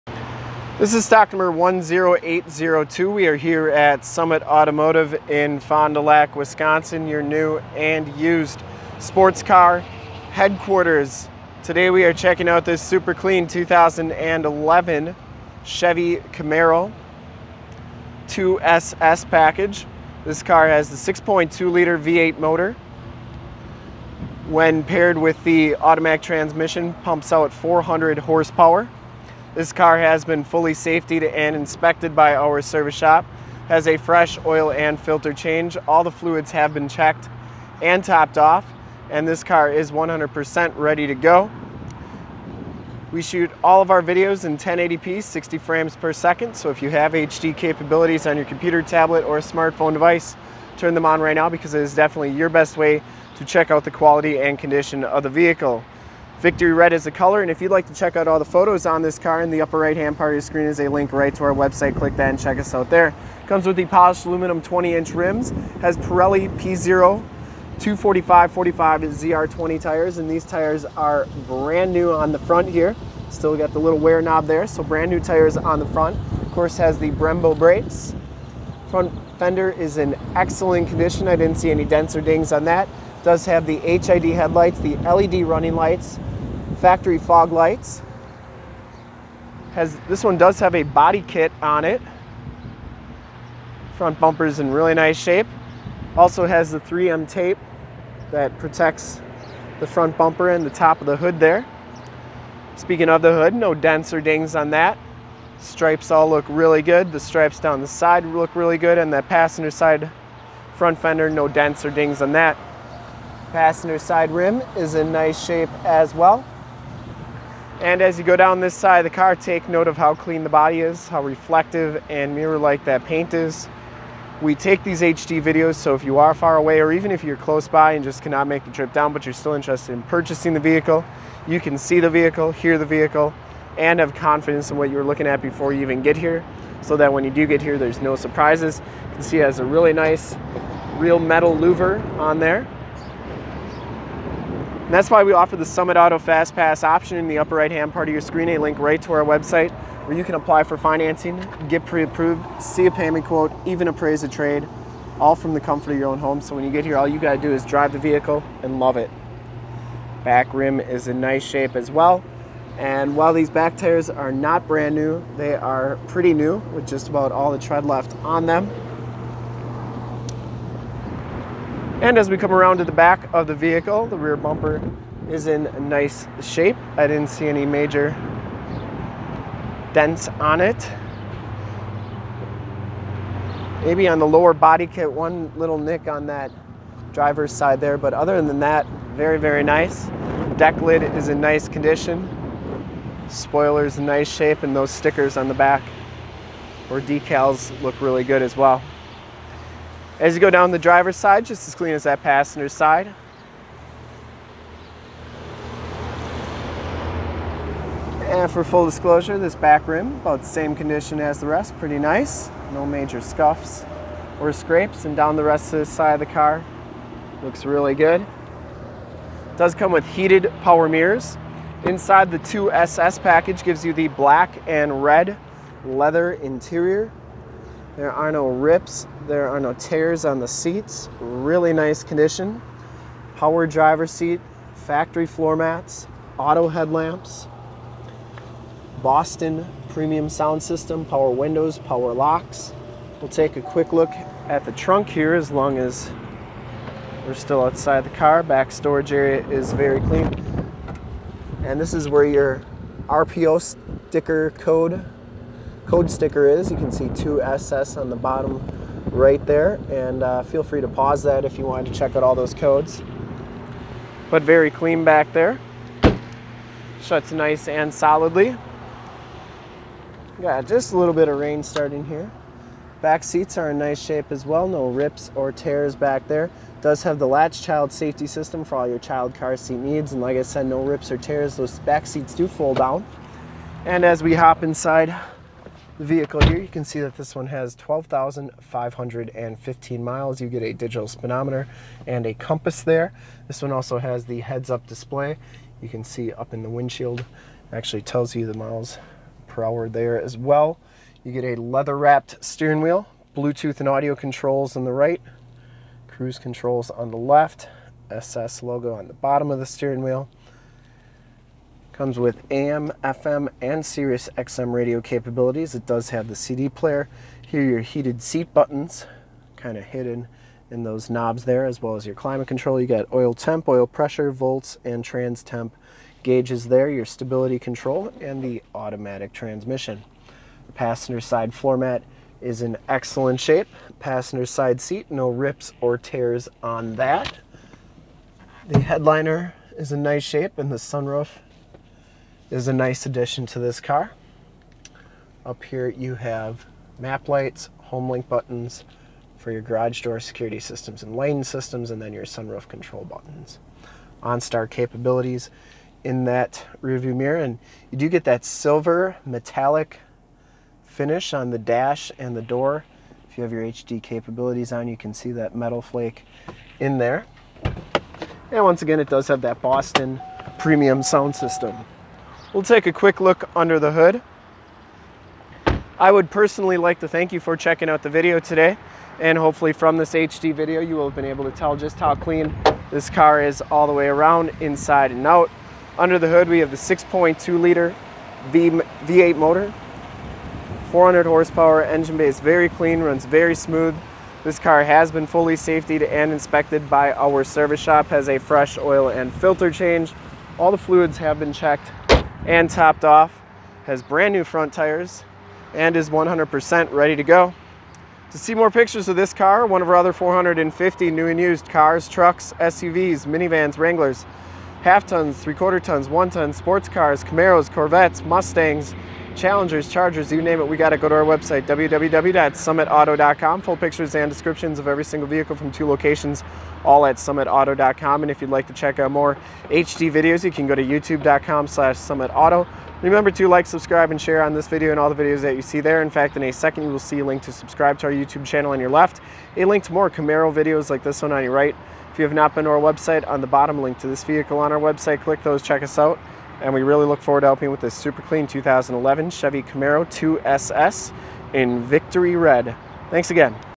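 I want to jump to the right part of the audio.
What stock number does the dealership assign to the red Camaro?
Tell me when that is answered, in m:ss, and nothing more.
0:01.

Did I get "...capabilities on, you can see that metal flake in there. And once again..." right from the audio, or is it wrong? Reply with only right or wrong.
right.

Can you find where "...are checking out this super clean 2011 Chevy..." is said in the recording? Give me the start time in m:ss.
0:12.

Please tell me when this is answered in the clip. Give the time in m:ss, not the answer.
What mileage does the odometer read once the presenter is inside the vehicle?
4:47.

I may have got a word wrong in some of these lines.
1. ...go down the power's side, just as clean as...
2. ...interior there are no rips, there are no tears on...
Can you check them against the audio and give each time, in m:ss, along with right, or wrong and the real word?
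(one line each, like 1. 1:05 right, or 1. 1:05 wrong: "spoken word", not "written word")
1. 3:20 wrong: "driver", not "power"
2. 3:46 right.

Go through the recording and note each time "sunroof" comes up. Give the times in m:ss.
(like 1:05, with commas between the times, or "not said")
5:40, 5:52.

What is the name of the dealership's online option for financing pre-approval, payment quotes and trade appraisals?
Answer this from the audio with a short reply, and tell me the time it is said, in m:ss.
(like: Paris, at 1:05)
Summit Auto Fast Pass, at 2:25.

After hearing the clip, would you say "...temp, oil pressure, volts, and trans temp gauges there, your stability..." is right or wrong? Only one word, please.
right.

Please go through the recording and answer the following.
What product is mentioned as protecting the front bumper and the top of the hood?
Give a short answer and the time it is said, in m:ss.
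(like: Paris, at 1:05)
3M tape, at 1:36.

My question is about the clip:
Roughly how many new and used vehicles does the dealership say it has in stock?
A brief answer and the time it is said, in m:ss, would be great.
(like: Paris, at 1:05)
450, at 6:50.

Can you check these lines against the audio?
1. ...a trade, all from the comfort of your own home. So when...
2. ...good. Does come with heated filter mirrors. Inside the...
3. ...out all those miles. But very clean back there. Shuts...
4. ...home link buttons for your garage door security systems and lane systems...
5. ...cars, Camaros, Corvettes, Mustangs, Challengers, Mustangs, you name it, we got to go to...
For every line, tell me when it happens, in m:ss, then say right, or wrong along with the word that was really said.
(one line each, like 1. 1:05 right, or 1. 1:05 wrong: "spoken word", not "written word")
1. 2:34 right
2. 3:37 wrong: "power", not "filter"
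3. 4:22 wrong: "codes", not "miles"
4. 5:47 right
5. 6:56 wrong: "Chargers", not "Mustangs".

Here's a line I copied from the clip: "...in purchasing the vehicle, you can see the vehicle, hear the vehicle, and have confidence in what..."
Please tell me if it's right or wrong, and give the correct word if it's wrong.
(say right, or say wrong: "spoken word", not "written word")
right.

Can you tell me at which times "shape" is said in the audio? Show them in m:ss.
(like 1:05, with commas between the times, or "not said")
1:35, 1:55, 2:41, 2:56, 3:14, 4:33, 5:33, 5:40.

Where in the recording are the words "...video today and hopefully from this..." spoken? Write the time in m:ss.
6:18.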